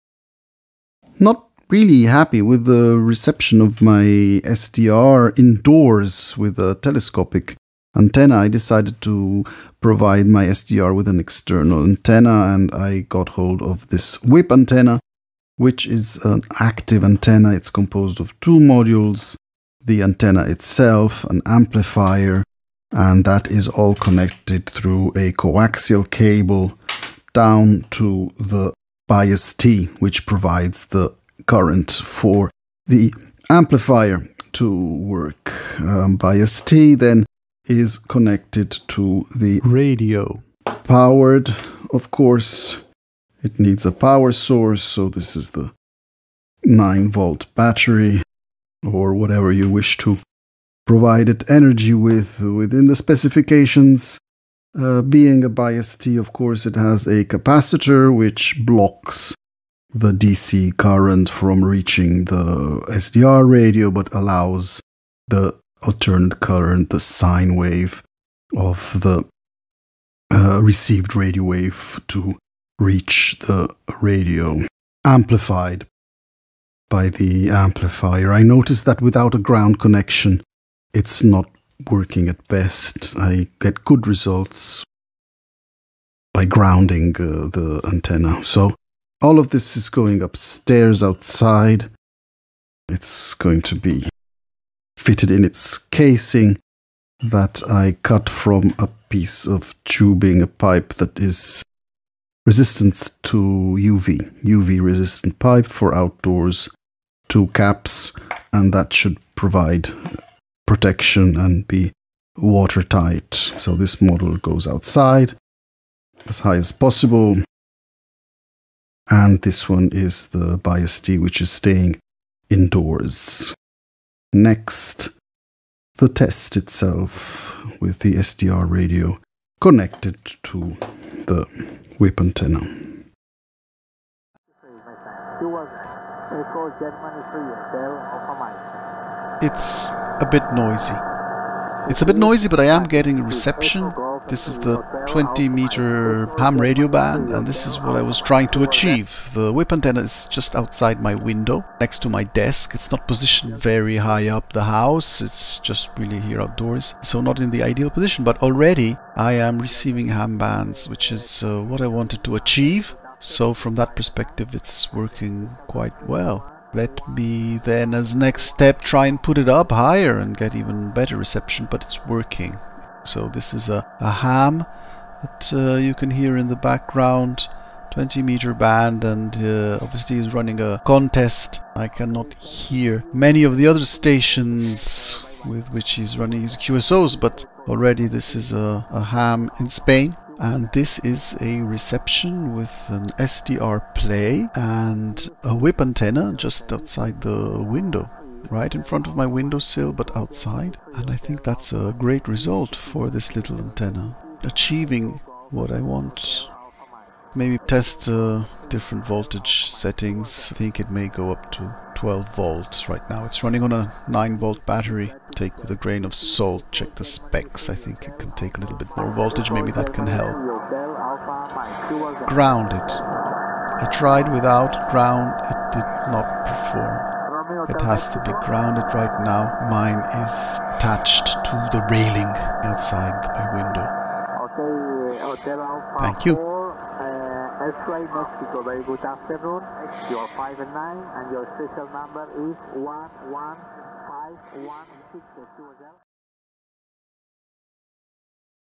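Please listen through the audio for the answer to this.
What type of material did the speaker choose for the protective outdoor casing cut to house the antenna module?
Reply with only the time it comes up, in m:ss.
1:44.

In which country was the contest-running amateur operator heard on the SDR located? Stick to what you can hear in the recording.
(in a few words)
Spain.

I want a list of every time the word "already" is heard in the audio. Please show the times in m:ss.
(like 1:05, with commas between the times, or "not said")
2:38, 3:07.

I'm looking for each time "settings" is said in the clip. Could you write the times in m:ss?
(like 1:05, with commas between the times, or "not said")
3:29.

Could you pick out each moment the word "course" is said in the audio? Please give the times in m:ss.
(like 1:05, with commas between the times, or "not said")
0:42, 0:56.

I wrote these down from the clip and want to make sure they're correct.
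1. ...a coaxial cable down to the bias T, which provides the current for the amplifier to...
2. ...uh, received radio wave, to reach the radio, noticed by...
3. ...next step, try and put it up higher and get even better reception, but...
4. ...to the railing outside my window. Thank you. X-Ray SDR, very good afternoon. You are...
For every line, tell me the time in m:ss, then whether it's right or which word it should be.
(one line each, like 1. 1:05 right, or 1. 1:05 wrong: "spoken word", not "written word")
1. 0:25 right
2. 1:10 wrong: "amplified", not "noticed"
3. 2:48 right
4. 3:51 wrong: "Mexico", not "SDR".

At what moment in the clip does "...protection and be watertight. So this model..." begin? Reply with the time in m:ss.
1:50.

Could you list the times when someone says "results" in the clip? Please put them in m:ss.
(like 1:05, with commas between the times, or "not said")
1:24, 3:22.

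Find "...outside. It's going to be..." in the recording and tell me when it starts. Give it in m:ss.
1:31.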